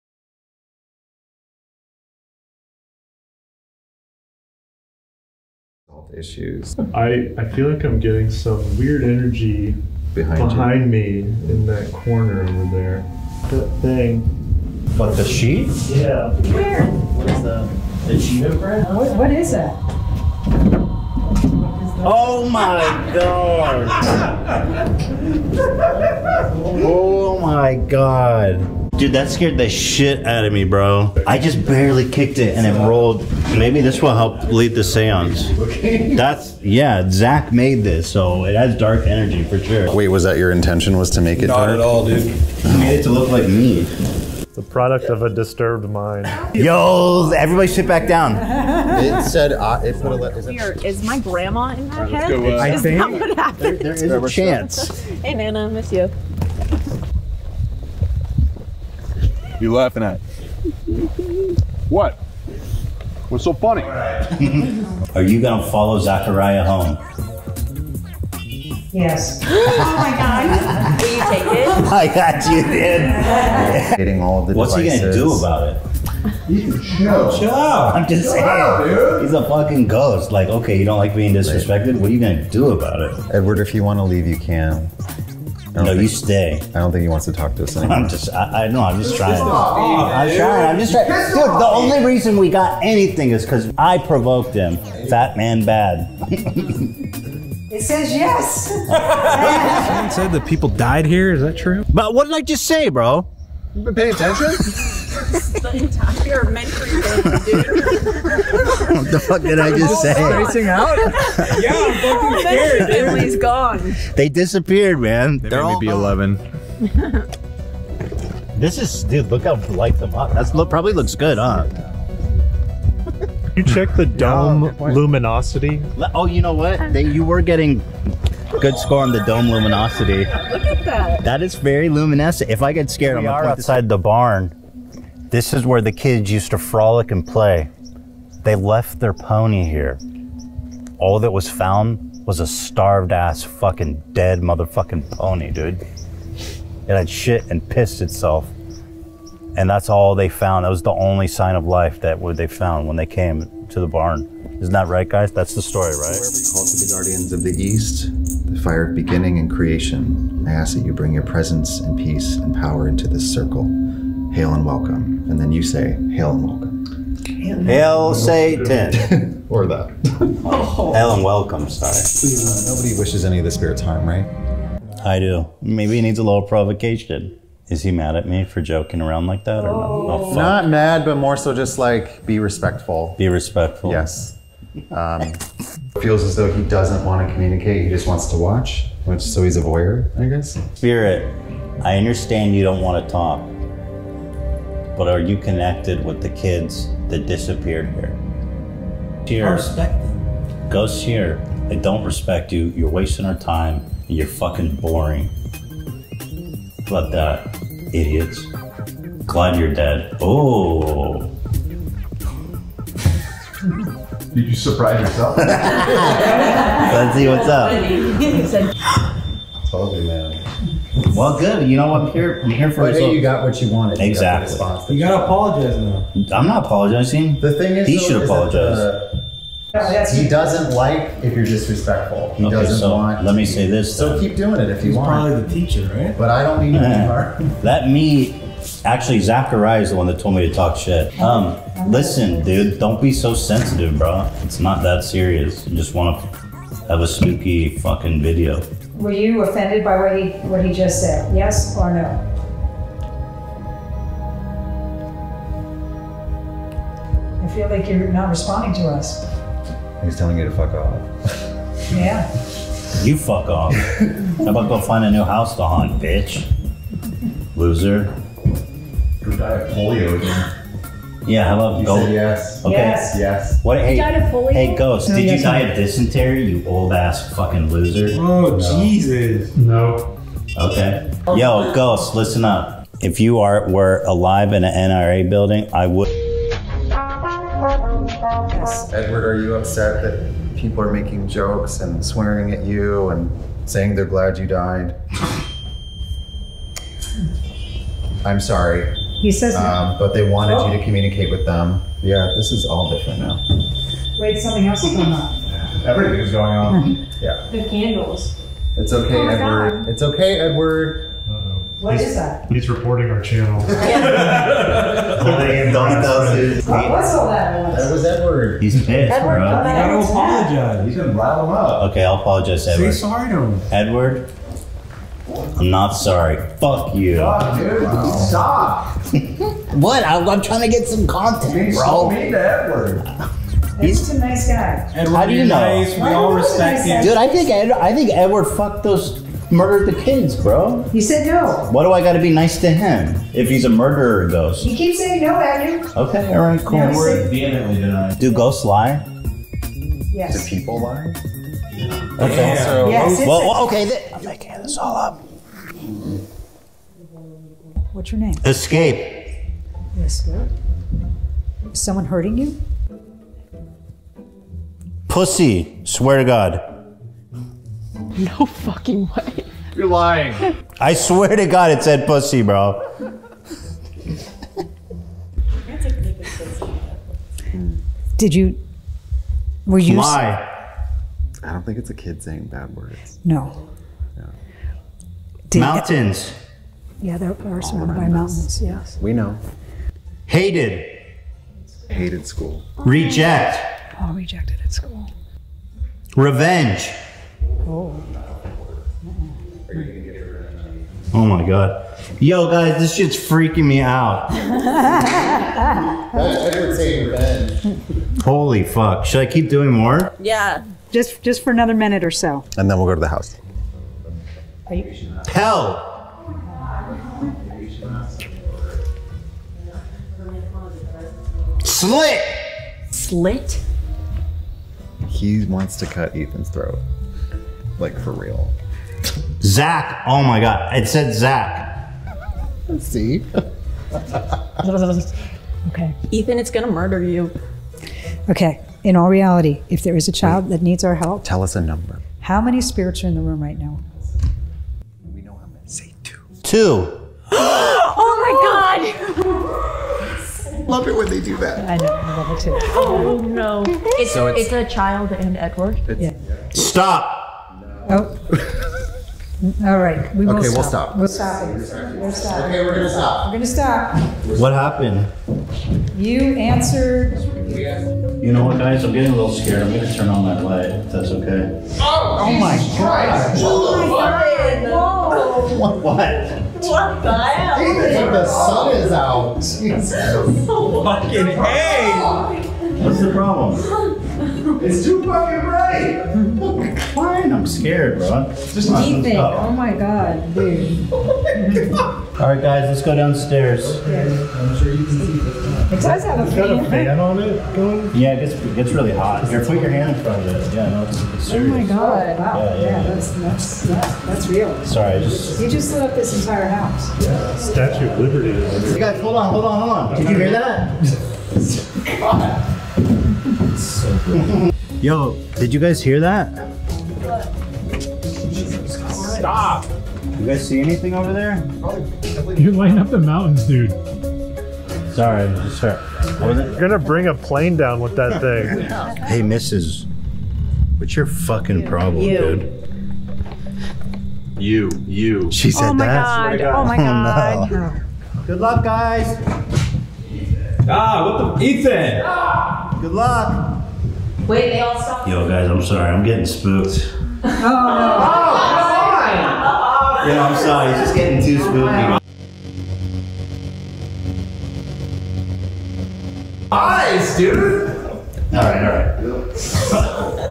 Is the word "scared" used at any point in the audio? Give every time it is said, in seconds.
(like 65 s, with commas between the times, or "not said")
29 s, 112 s, 132 s, 469 s, 487 s.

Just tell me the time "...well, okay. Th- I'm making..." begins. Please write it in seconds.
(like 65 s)
353 s.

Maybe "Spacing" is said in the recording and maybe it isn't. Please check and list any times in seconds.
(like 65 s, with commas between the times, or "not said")
110 s.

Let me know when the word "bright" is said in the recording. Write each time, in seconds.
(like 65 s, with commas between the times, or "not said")
485 s.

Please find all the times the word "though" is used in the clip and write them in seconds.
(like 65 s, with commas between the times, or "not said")
186 s, 227 s.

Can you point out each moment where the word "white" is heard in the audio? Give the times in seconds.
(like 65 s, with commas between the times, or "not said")
not said.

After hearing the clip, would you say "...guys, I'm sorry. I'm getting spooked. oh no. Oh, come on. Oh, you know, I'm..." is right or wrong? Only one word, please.
right.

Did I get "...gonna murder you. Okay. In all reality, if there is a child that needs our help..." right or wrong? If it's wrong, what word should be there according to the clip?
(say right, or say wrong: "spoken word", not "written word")
right.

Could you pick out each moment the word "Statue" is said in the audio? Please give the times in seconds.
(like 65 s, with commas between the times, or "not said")
507 s.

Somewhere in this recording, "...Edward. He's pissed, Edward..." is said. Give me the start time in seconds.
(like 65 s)
318 s.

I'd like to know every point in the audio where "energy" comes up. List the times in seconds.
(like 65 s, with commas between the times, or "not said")
9 s, 39 s.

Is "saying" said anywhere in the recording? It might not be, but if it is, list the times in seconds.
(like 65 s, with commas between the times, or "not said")
78 s, 293 s, 344 s, 382 s.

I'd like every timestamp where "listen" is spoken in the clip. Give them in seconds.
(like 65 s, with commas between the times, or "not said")
241 s, 282 s.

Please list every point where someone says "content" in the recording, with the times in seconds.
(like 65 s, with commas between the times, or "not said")
331 s.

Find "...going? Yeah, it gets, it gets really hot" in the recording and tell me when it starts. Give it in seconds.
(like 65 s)
497 s.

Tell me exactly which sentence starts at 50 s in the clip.
Is, my grandma in my head?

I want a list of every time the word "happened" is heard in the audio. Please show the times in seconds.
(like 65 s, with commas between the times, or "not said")
53 s, 464 s.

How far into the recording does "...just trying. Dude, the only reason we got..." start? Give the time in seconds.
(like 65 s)
90 s.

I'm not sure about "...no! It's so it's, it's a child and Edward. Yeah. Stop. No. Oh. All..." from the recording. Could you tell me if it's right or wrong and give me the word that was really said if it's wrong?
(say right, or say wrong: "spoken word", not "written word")
right.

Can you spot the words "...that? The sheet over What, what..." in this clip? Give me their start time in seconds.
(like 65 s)
17 s.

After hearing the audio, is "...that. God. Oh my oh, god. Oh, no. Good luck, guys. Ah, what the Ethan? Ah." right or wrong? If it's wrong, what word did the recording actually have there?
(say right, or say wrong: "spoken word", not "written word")
right.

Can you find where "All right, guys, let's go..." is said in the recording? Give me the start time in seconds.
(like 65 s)
491 s.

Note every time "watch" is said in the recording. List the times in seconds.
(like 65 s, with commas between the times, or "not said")
188 s.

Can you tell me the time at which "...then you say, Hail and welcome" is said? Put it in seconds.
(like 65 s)
165 s.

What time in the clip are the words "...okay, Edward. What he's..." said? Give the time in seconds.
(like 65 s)
310 s.